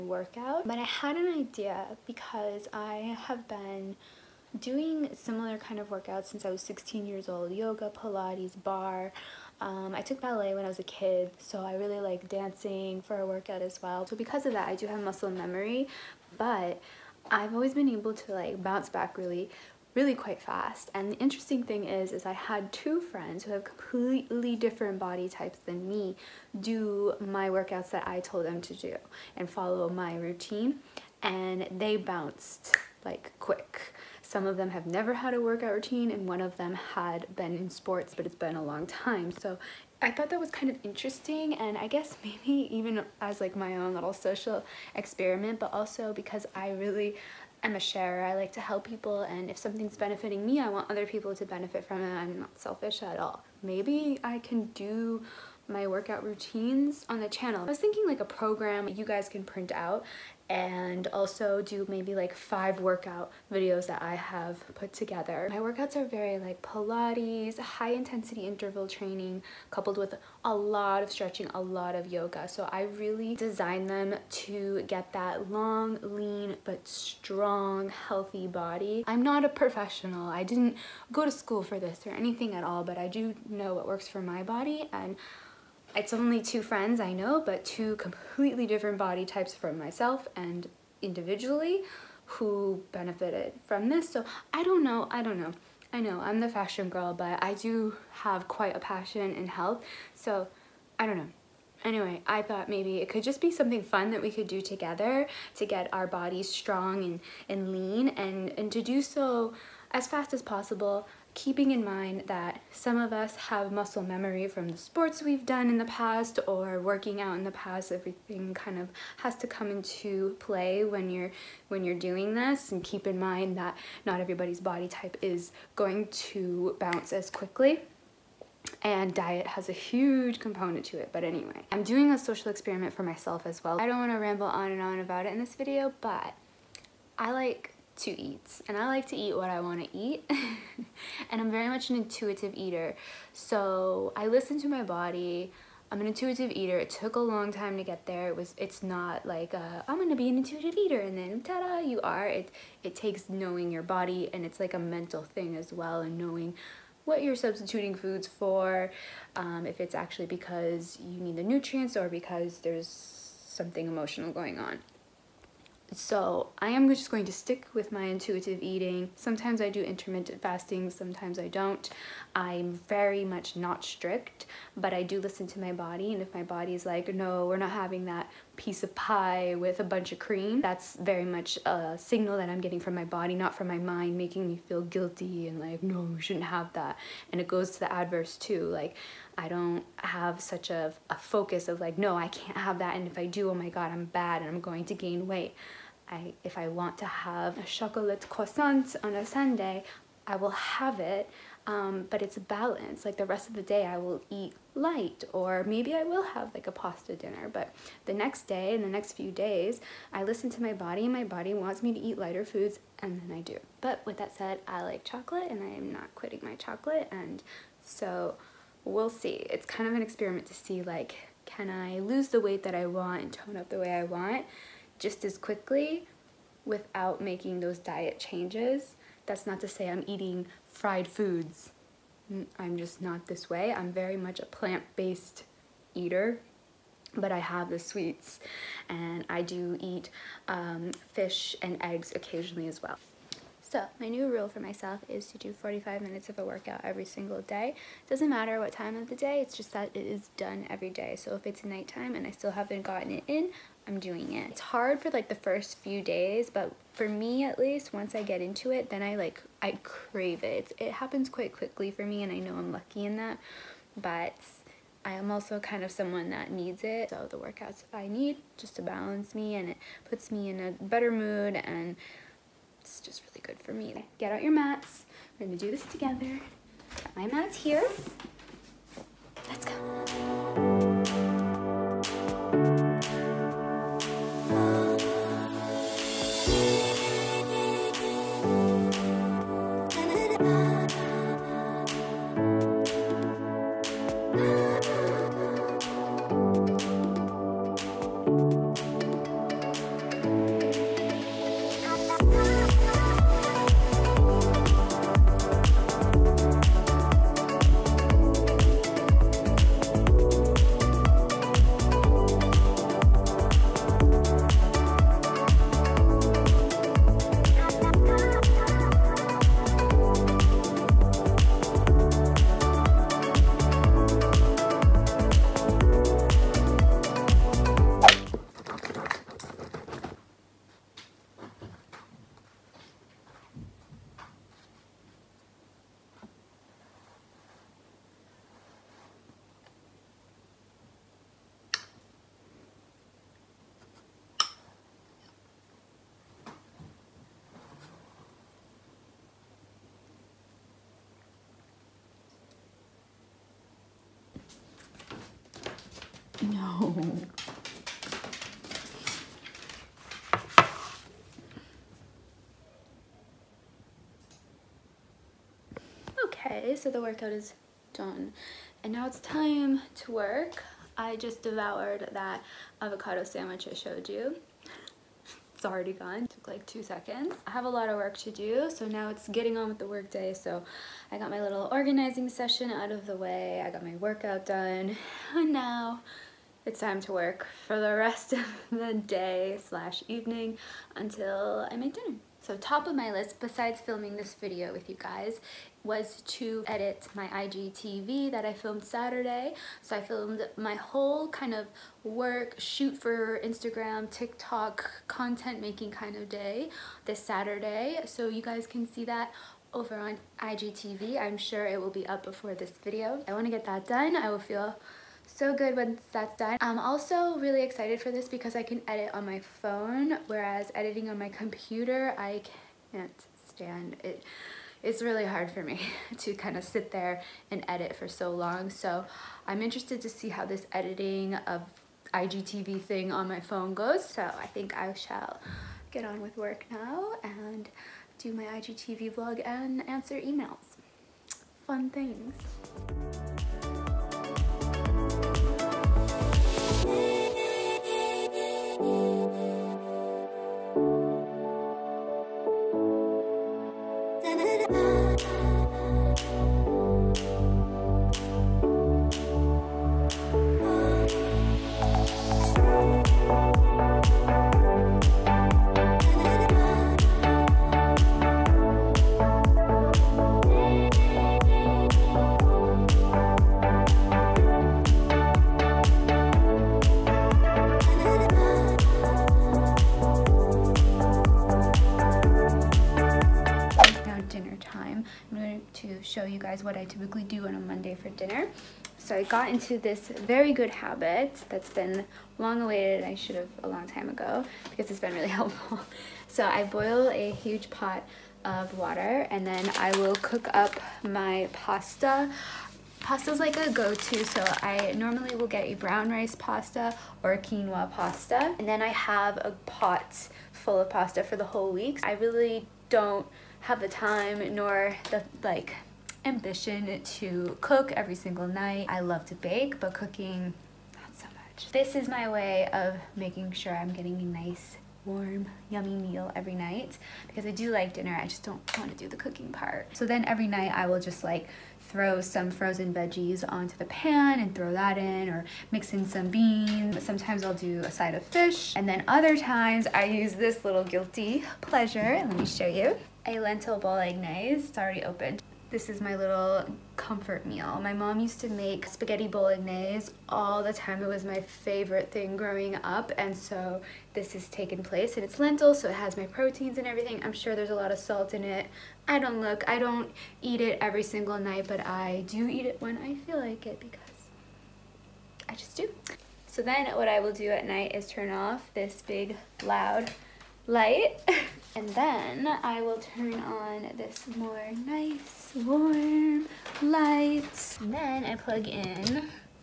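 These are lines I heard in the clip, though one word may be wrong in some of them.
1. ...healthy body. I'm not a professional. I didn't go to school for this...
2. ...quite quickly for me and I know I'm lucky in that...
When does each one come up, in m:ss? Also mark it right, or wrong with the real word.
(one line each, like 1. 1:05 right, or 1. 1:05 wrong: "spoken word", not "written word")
1. 1:17 right
2. 4:21 right.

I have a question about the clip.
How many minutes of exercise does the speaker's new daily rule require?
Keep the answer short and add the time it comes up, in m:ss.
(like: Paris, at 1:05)
45, at 4:05.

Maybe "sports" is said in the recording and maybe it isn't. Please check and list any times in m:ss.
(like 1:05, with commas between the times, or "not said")
0:37, 1:54.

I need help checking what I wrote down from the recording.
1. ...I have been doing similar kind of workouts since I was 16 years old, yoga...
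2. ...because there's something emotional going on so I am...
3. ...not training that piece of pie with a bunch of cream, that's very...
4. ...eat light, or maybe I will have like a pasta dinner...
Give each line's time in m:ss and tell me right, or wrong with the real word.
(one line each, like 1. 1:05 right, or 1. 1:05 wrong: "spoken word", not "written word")
1. 0:02 right
2. 2:42 right
3. 2:57 wrong: "having", not "training"
4. 3:24 right.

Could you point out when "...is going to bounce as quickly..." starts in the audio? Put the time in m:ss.
2:05.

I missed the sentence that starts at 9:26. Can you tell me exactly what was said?
So then what I will do at night is turn off this big loud light.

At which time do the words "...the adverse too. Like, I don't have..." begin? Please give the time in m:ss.
3:07.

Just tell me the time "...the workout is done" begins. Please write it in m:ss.
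6:06.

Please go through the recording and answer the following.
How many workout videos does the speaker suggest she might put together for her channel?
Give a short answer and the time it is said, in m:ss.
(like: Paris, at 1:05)
5, at 1:02.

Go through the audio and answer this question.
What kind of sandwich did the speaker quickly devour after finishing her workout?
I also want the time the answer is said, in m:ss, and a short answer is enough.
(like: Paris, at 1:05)
Avocado sandwich, at 6:12.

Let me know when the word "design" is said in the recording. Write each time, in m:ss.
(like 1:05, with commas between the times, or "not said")
1:13.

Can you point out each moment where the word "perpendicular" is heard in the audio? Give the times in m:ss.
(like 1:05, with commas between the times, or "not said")
not said.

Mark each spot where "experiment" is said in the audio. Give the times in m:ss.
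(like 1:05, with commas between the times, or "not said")
0:44, 2:12, 3:40.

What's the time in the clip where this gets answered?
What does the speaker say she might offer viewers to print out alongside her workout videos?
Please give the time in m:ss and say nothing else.
0:58.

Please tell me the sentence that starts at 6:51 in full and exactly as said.
I'm sure it will be up before this video.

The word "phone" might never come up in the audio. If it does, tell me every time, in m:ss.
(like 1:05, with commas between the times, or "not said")
6:59, 7:13.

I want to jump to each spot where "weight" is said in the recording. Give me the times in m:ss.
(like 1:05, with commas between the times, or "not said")
3:15, 3:42.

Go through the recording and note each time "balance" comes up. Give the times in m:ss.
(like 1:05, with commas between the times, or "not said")
3:22, 4:28.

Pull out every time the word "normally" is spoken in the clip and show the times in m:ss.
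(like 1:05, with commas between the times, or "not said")
8:24.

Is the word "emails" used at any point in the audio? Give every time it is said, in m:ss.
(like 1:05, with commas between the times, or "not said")
7:20.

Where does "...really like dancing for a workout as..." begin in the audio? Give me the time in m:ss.
0:11.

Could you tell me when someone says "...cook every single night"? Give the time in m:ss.
8:37.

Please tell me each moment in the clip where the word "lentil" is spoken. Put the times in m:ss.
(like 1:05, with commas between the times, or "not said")
9:03, 9:15.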